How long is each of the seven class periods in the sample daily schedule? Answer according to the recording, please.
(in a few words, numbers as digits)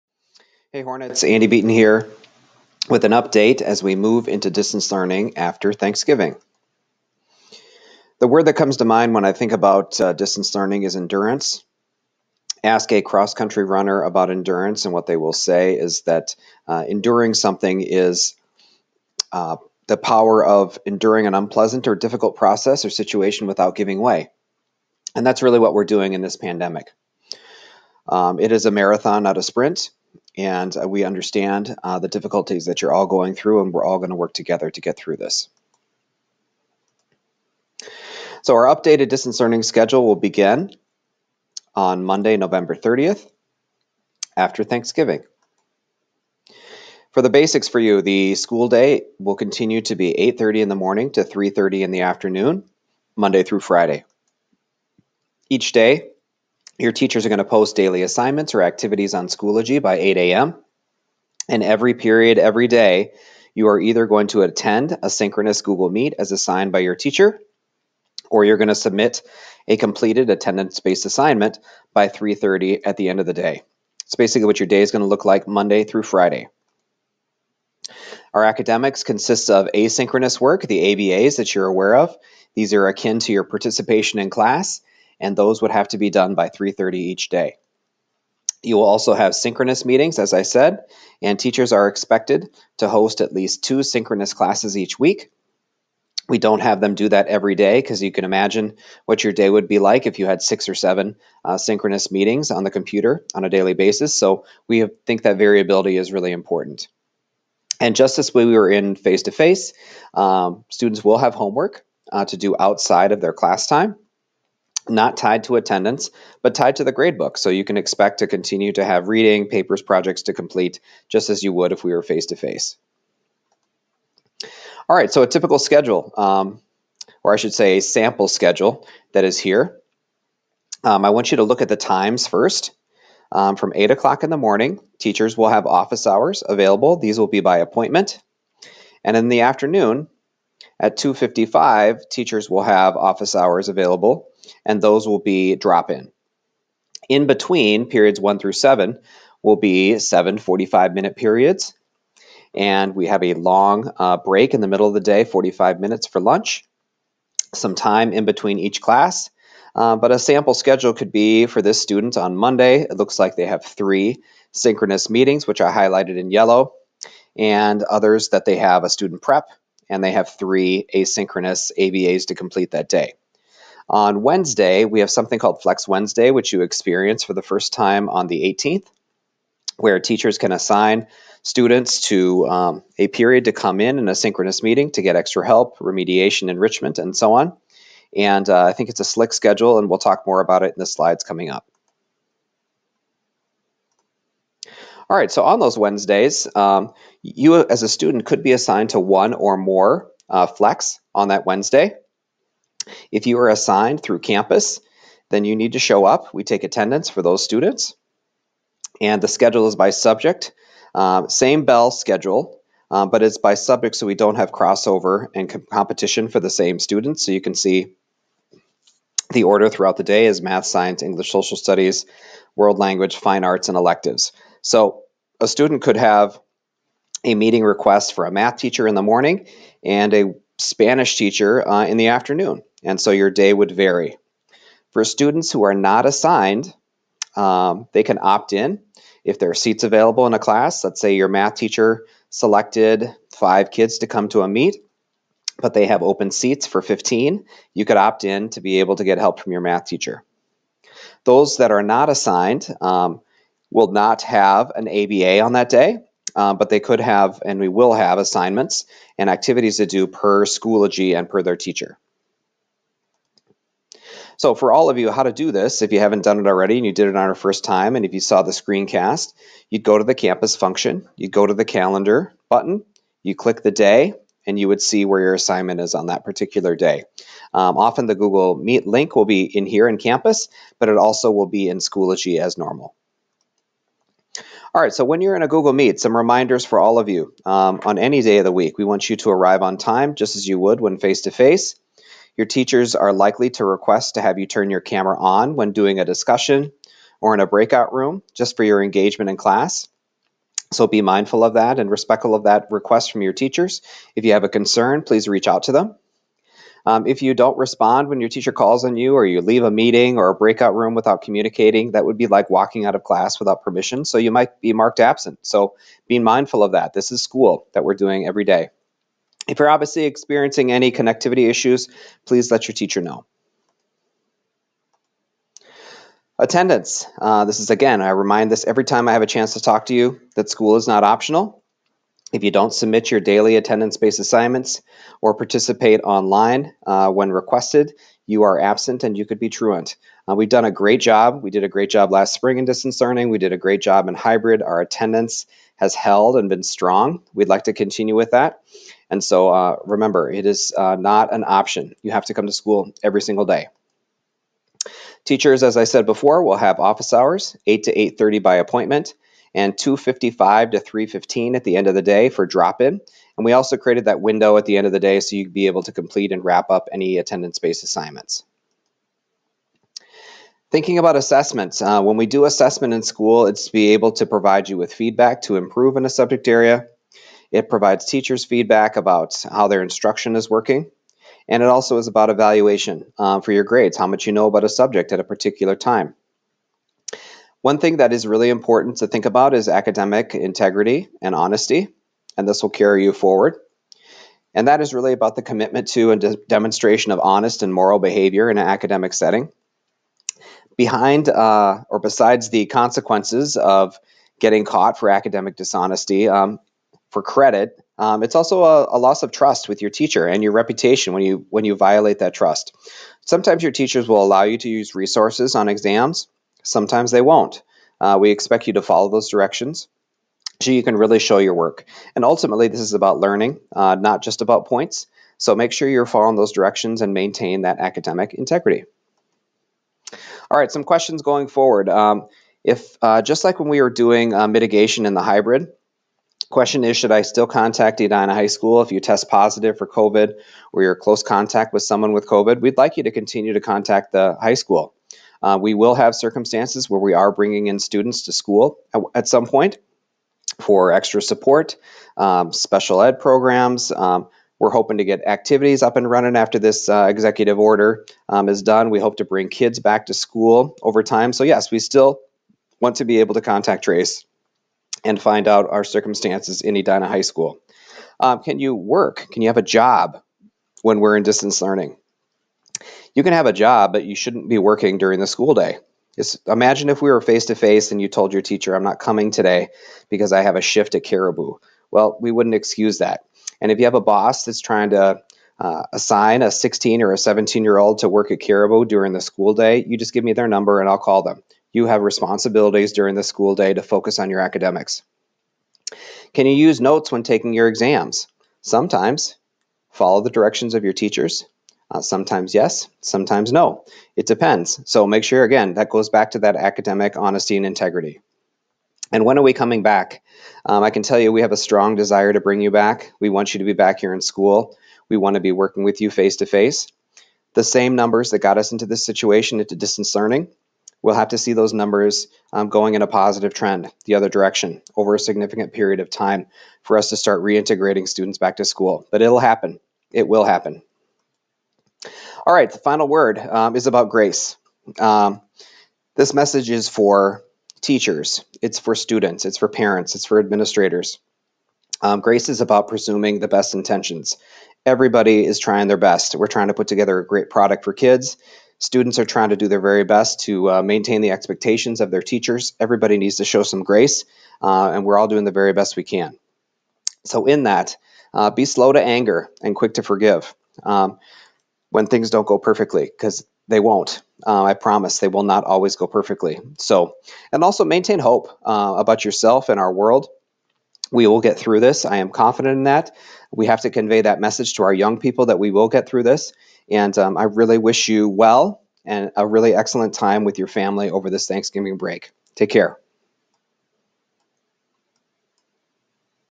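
45 minutes.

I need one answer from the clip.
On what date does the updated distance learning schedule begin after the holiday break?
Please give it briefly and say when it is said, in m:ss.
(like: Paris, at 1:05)
November 30th, at 0:42.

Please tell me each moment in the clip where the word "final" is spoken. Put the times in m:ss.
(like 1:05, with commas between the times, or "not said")
8:52.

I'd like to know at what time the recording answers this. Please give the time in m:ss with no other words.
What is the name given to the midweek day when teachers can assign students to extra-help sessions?
2:55.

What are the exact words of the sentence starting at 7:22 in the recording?
We'd like you to continue to contact the high school.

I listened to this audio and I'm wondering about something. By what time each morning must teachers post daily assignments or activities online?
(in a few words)
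8 a.m.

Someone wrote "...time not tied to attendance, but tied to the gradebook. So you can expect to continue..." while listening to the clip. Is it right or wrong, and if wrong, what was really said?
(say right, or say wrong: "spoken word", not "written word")
right.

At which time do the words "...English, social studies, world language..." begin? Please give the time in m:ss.
3:41.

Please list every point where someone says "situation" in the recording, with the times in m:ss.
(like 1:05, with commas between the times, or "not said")
0:22, 8:39.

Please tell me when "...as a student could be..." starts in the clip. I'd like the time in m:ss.
3:17.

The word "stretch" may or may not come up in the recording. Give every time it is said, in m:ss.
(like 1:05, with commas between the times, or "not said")
not said.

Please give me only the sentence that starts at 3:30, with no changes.
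Um, same bell schedule, um, but it's by subject so we don't have crossover and com competition for the same students.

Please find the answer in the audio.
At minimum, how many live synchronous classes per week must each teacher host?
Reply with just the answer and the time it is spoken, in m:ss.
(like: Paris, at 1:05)
2, at 1:33.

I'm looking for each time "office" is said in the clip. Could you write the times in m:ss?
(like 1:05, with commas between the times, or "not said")
2:15, 2:22, 5:56.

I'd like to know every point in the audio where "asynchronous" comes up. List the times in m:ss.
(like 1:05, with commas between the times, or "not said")
1:19, 2:50.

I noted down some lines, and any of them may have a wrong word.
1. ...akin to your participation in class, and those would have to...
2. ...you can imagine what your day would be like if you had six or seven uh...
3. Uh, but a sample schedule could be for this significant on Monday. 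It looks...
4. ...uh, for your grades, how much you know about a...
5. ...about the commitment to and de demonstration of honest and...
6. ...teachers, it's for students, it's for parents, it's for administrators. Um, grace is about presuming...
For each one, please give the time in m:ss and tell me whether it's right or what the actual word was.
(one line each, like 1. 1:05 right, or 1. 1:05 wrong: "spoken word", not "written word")
1. 1:22 right
2. 1:38 right
3. 2:39 wrong: "student", not "significant"
4. 6:23 right
5. 6:35 right
6. 8:57 right.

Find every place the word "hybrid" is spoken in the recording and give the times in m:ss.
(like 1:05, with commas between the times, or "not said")
5:44, 7:15.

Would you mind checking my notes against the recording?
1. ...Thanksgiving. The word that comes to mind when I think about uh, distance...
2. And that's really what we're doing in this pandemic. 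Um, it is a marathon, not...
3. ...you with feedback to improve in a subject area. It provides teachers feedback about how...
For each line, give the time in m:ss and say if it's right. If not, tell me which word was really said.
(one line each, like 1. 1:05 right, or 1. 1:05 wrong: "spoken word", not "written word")
1. 0:05 right
2. 0:25 right
3. 6:14 right.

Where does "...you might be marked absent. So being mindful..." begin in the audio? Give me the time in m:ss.
5:14.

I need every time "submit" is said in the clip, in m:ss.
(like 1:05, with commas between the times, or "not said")
1:08, 5:32.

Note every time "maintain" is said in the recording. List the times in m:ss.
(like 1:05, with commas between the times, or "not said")
7:07, 9:10, 9:27.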